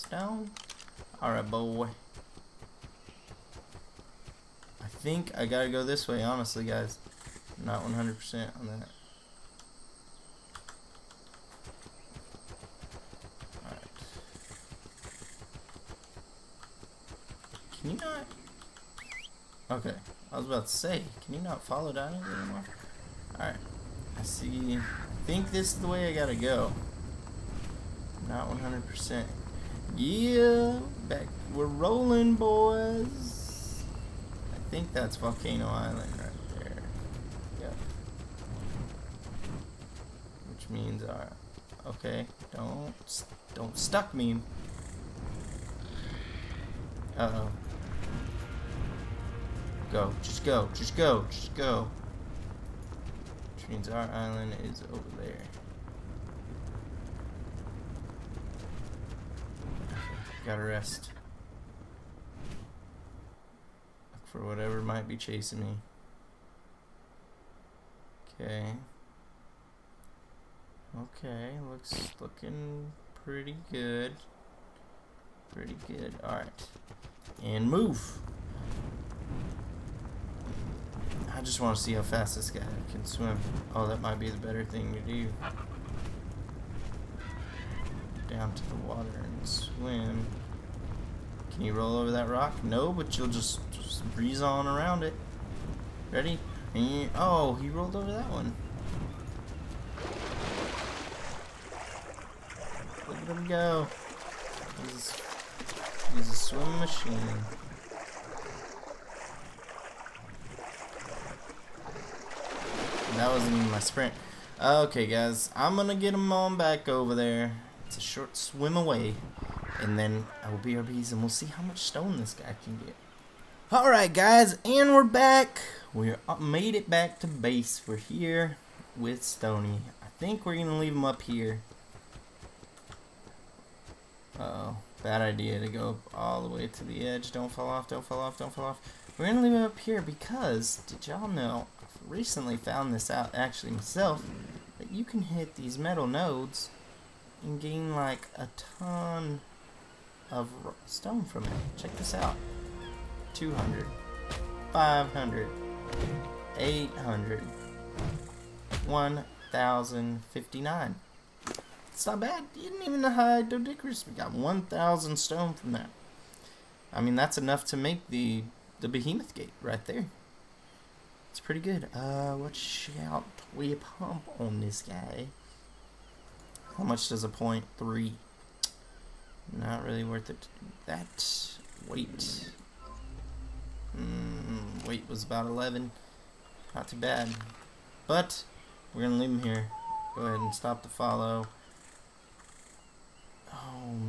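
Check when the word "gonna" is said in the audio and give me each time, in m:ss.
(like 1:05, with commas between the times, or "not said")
1:55, 2:10, 2:19, 3:09.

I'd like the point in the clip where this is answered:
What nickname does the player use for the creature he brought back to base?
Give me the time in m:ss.
2:09.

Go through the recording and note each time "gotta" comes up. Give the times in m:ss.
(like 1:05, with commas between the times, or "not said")
0:05, 0:26, 1:00.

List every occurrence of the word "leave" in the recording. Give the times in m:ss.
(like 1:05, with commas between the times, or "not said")
2:10, 2:19, 3:09.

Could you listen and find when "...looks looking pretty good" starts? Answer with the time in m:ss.
1:11.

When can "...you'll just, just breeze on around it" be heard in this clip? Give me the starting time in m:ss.
1:33.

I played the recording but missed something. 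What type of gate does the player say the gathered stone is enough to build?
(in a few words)
behemoth gate.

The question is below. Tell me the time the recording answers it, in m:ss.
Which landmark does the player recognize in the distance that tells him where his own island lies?
0:35.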